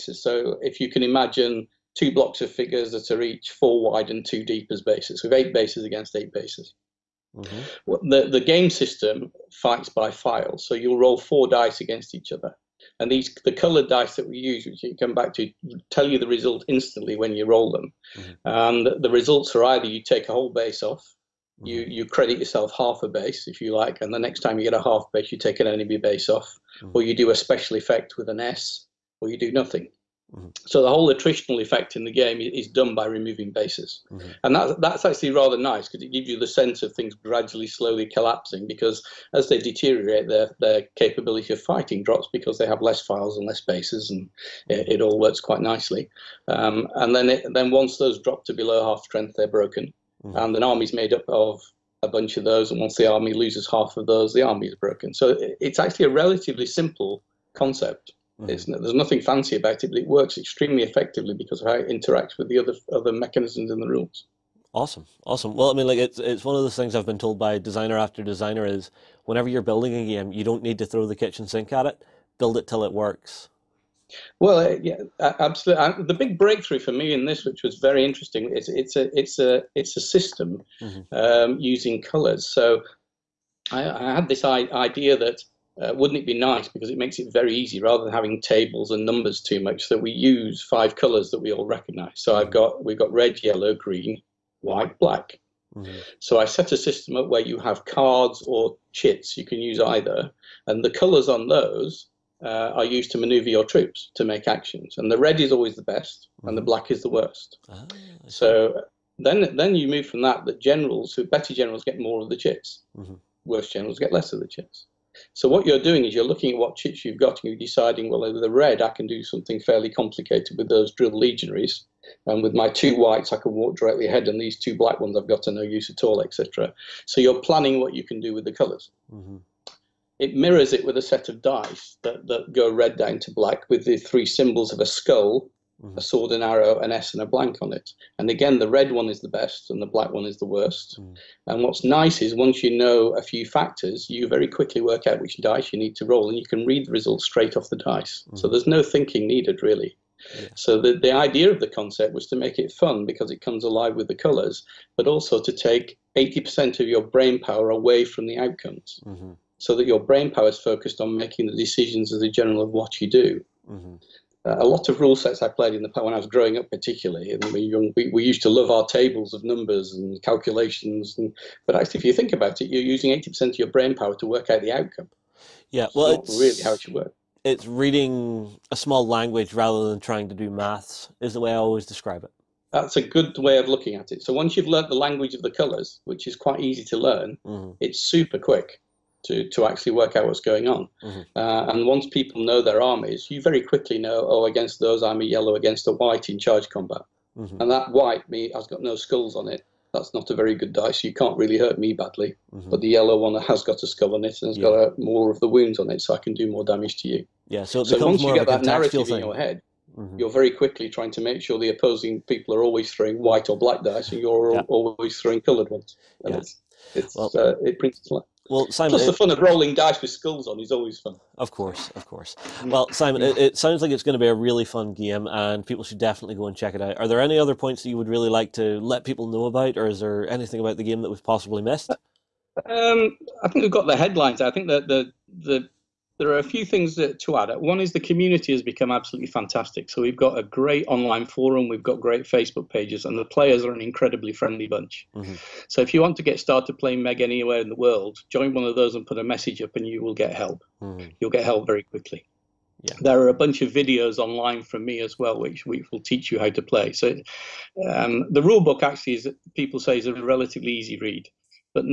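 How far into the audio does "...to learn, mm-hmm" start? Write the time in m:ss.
3:06.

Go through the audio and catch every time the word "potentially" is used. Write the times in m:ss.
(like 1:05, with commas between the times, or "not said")
not said.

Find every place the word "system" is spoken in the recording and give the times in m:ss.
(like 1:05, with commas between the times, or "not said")
0:08, 1:20, 1:36.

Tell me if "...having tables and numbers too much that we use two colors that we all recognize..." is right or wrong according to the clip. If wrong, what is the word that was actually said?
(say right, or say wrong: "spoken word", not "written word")
wrong: "five", not "two".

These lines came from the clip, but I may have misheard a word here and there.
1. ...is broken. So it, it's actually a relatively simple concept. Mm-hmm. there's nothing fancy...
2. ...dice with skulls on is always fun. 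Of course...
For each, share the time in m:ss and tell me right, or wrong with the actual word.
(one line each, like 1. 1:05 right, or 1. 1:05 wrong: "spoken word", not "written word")
1. 0:54 right
2. 3:39 right.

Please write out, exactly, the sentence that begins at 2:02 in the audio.
And with my two whites, I can walk directly ahead, and these two black ones I've got no use at all, etc.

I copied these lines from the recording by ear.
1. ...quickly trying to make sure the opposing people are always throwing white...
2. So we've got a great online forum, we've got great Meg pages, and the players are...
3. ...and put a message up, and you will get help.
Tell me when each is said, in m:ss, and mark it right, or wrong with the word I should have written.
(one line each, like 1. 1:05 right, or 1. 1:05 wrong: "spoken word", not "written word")
1. 3:30 right
2. 3:59 wrong: "Facebook", not "Meg"
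3. 4:08 right.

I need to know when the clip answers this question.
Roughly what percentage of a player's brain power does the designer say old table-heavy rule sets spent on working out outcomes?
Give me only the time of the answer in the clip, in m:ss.
2:53.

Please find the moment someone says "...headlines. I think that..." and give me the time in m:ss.
3:53.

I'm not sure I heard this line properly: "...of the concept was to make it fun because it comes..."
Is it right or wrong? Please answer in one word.
right.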